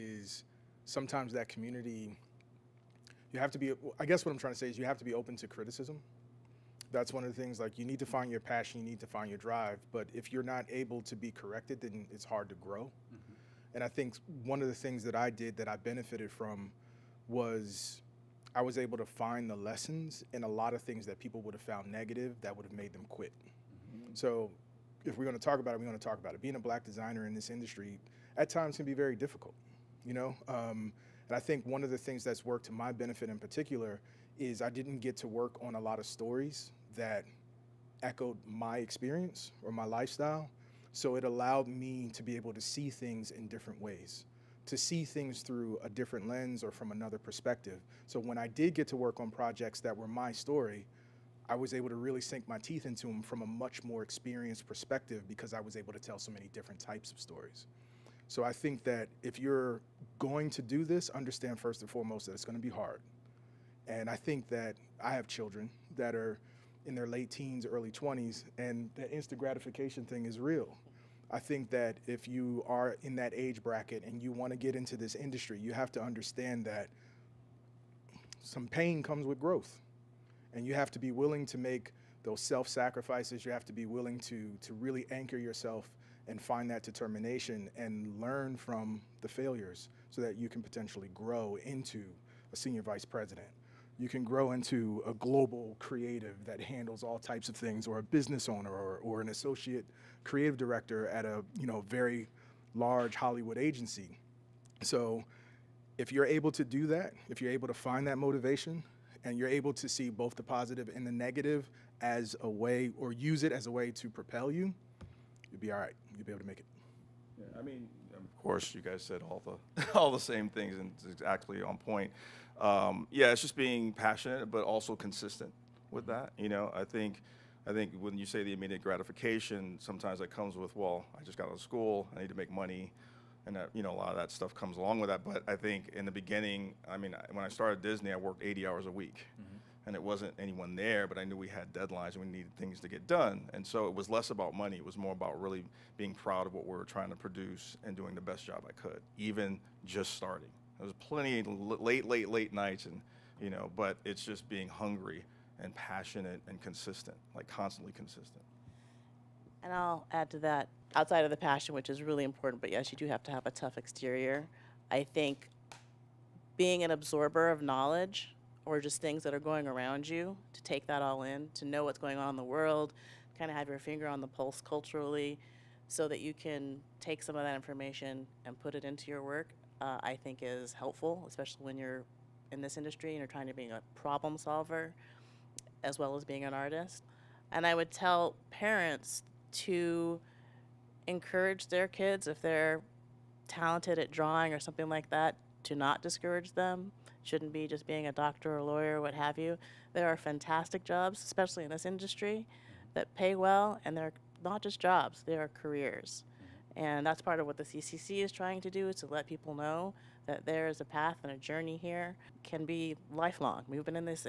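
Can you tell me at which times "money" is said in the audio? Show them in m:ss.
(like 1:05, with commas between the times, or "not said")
2:12, 2:24.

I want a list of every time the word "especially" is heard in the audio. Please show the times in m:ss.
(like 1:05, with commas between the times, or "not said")
3:01, 3:21.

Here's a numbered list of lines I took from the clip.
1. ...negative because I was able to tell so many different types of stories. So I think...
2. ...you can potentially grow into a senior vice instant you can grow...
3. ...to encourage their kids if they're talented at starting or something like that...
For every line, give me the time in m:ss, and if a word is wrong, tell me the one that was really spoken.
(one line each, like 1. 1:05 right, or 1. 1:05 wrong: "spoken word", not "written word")
1. 0:54 wrong: "perspective", not "negative"
2. 1:30 wrong: "president", not "instant"
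3. 3:09 wrong: "drawing", not "starting".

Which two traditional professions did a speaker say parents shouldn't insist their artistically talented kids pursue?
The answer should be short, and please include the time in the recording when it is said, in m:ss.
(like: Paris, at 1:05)
Doctor or lawyer, at 3:18.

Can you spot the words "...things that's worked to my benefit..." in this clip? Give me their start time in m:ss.
0:31.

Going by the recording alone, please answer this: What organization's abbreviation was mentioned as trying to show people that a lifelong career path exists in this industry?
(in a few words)
CCC.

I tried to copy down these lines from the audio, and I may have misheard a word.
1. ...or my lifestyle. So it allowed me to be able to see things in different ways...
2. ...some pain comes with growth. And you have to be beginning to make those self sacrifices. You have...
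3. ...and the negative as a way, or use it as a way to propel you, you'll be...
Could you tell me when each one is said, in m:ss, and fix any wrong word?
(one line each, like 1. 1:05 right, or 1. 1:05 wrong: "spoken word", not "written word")
1. 0:39 right
2. 1:18 wrong: "willing", not "beginning"
3. 1:50 right.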